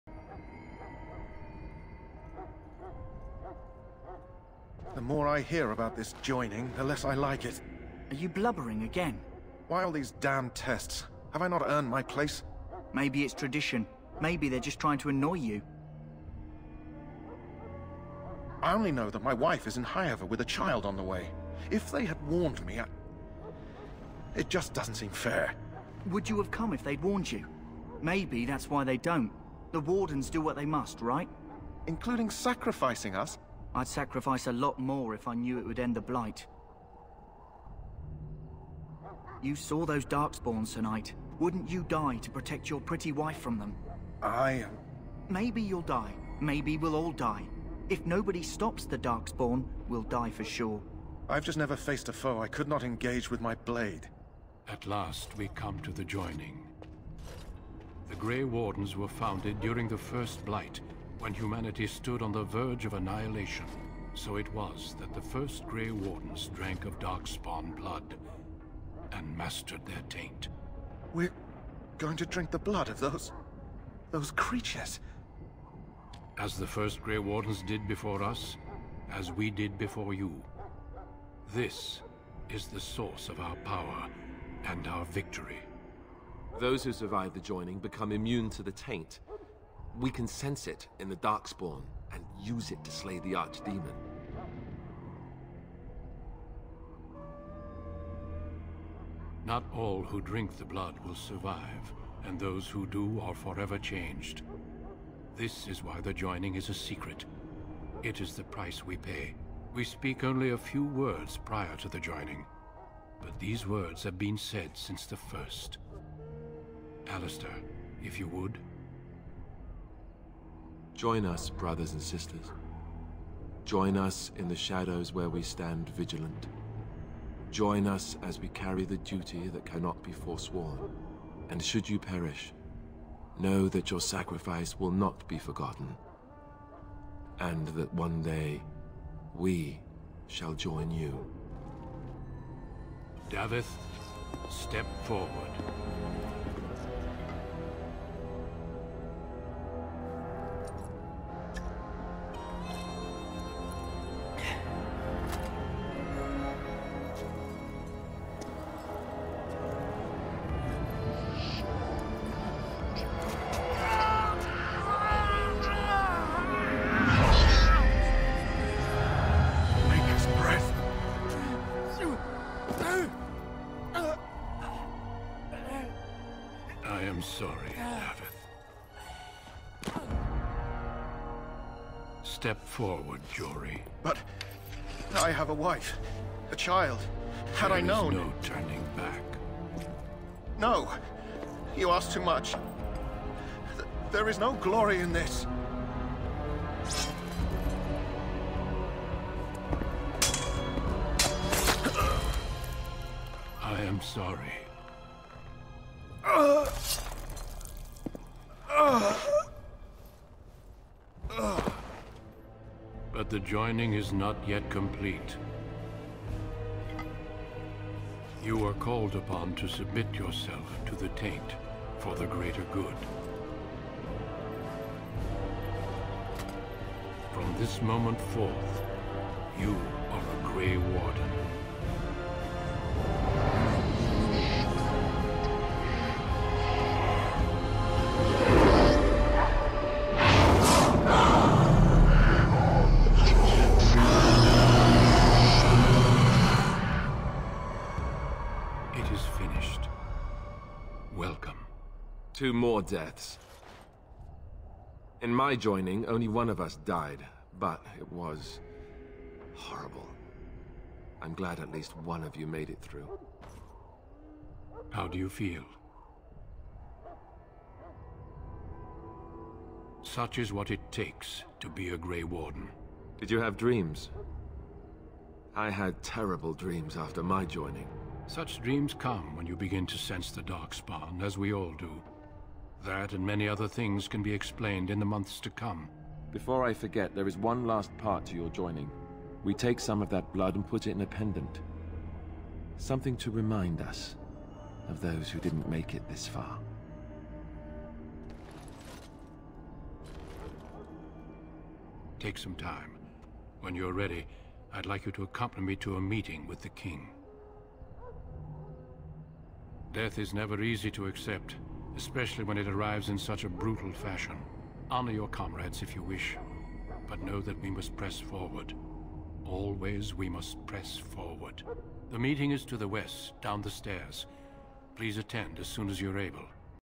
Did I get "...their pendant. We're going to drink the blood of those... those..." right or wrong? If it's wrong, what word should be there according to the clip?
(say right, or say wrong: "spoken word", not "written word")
wrong: "taint", not "pendant".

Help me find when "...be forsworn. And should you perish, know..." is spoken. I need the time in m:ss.
2:10.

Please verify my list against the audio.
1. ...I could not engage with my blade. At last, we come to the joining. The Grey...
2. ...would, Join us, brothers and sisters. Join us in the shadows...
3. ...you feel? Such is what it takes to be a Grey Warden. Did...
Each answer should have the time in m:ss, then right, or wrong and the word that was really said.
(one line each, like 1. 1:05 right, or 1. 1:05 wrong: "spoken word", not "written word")
1. 0:52 right
2. 1:58 right
3. 4:25 right.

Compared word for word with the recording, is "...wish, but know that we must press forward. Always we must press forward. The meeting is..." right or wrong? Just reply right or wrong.
right.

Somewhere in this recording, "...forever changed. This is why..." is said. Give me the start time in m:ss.
1:43.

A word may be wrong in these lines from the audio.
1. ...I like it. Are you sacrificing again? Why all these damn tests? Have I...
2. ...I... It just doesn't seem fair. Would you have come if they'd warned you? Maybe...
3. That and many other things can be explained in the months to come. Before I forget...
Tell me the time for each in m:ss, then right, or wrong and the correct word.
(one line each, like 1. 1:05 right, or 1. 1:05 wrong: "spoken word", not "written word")
1. 0:07 wrong: "blubbering", not "sacrificing"
2. 0:22 right
3. 4:42 right.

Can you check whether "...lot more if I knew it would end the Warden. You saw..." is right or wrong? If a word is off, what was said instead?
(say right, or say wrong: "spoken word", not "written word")
wrong: "Blight", not "Warden".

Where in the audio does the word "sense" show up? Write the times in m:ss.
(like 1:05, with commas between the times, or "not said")
1:30, 4:39.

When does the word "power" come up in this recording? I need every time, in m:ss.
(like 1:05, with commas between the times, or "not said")
1:23.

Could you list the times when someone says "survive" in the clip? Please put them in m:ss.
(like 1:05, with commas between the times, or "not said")
1:26, 1:41.